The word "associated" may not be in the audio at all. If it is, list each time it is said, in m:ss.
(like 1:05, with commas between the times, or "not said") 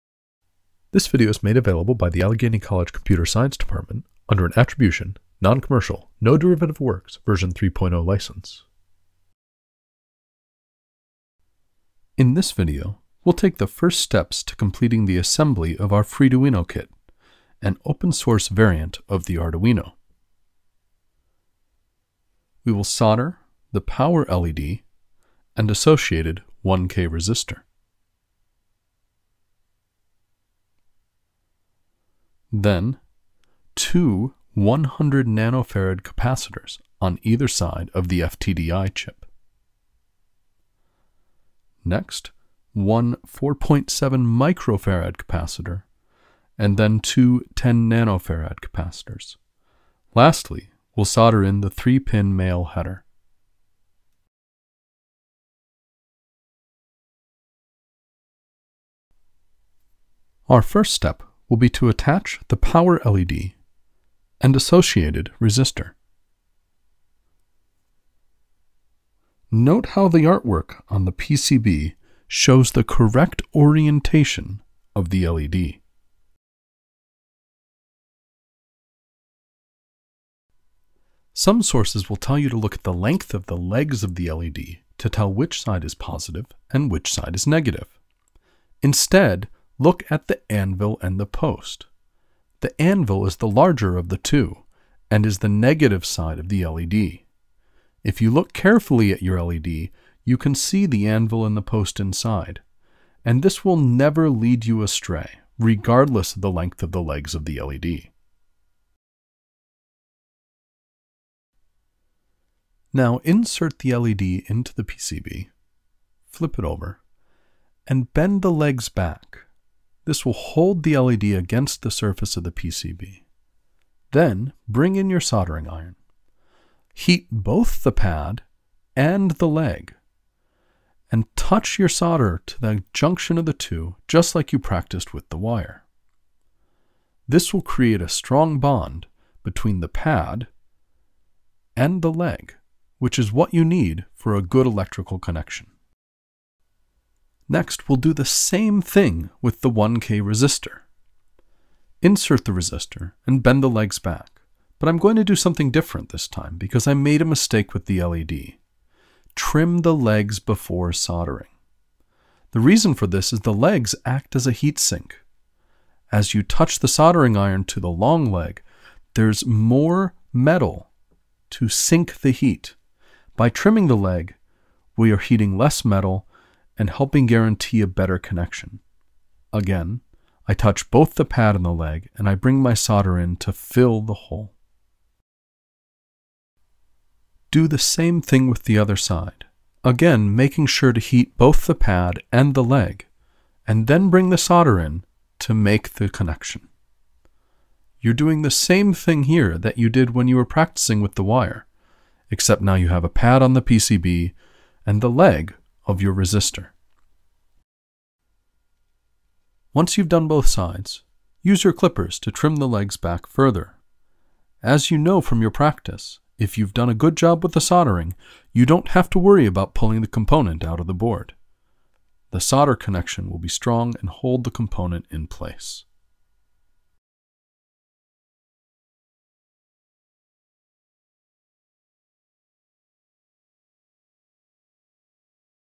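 0:25, 1:04.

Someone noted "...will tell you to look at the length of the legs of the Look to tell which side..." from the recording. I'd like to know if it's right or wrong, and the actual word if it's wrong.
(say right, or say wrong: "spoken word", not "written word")
wrong: "LED", not "Look".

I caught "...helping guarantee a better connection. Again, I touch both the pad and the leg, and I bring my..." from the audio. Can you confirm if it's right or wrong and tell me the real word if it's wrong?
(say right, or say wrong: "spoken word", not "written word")
right.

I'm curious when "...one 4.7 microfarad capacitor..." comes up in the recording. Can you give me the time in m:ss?
0:42.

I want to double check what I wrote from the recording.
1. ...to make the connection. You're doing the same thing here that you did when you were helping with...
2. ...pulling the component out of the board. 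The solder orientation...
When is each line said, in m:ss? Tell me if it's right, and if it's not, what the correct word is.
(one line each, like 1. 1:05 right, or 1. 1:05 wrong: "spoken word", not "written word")
1. 3:15 wrong: "practicing", not "helping"
2. 3:39 wrong: "connection", not "orientation".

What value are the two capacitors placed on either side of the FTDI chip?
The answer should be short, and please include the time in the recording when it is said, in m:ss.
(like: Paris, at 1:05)
100 nanofarad, at 0:34.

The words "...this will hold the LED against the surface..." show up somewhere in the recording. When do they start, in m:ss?
2:00.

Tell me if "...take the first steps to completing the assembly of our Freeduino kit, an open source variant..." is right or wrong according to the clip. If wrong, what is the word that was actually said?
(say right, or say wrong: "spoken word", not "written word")
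right.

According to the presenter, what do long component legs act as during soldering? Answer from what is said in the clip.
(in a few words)
a heat sink.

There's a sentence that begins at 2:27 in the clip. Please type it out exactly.
Next, we'll do the same thing with the 1K resistor.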